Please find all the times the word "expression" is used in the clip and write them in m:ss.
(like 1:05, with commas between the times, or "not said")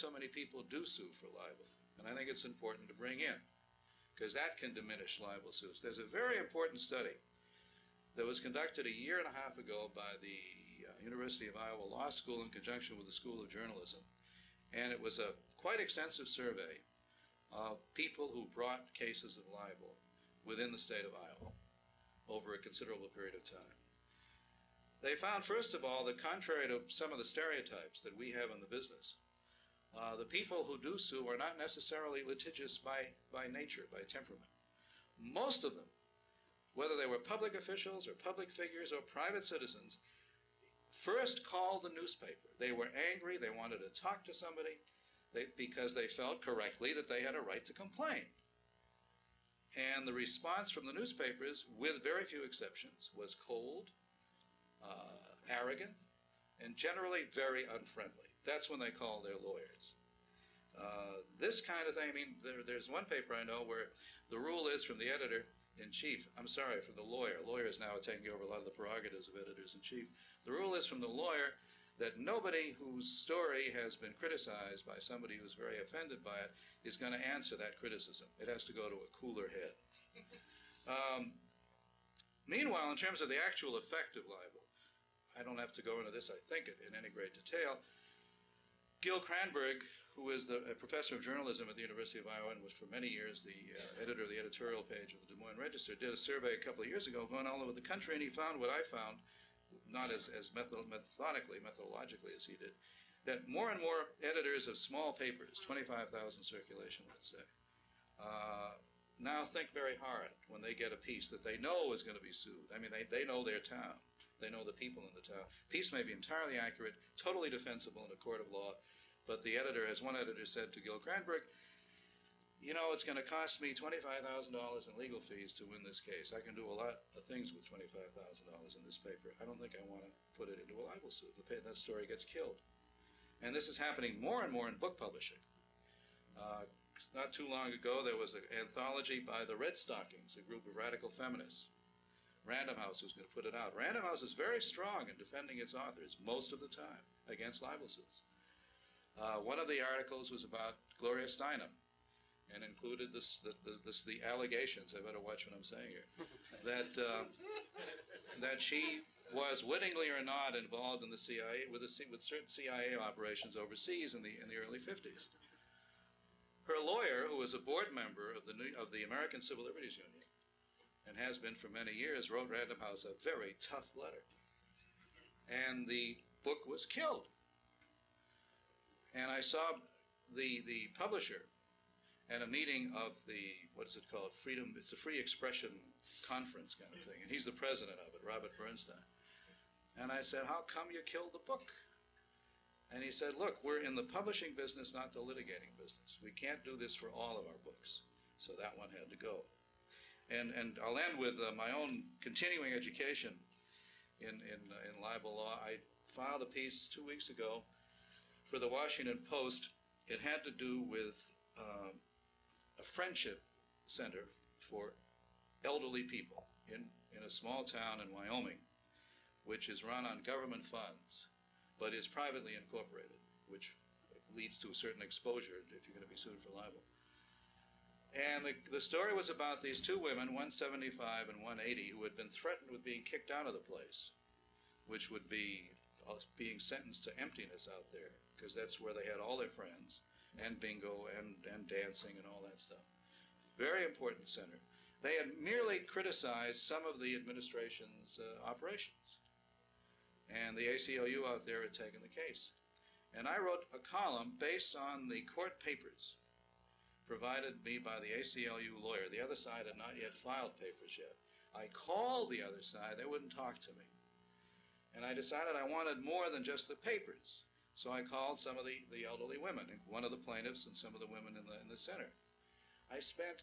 3:05.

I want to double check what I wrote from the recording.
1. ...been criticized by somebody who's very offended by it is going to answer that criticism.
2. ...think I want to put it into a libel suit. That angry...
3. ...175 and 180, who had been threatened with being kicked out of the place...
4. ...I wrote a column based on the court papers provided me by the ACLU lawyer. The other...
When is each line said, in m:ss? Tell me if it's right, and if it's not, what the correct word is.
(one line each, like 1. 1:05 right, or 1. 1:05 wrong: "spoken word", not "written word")
1. 1:13 right
2. 2:09 wrong: "story", not "angry"
3. 3:50 right
4. 4:13 right.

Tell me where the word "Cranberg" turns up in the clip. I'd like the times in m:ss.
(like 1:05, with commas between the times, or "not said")
1:29, 2:00.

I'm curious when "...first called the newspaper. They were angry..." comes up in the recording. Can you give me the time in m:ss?
0:40.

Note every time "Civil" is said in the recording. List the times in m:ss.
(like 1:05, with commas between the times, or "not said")
2:49.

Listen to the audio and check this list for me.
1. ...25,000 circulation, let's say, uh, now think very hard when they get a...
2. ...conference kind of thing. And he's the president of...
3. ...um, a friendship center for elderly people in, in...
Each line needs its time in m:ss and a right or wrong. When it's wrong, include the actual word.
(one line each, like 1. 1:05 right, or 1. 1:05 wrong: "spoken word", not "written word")
1. 1:45 right
2. 3:06 right
3. 3:31 right.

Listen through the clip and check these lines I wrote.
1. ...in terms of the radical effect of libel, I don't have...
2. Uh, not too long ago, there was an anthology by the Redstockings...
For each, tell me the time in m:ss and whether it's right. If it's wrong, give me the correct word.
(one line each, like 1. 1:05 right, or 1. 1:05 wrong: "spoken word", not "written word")
1. 1:22 wrong: "actual", not "radical"
2. 2:16 right.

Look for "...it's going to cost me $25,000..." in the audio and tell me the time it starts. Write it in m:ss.
2:02.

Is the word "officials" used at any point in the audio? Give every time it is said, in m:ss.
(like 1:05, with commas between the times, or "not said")
0:37.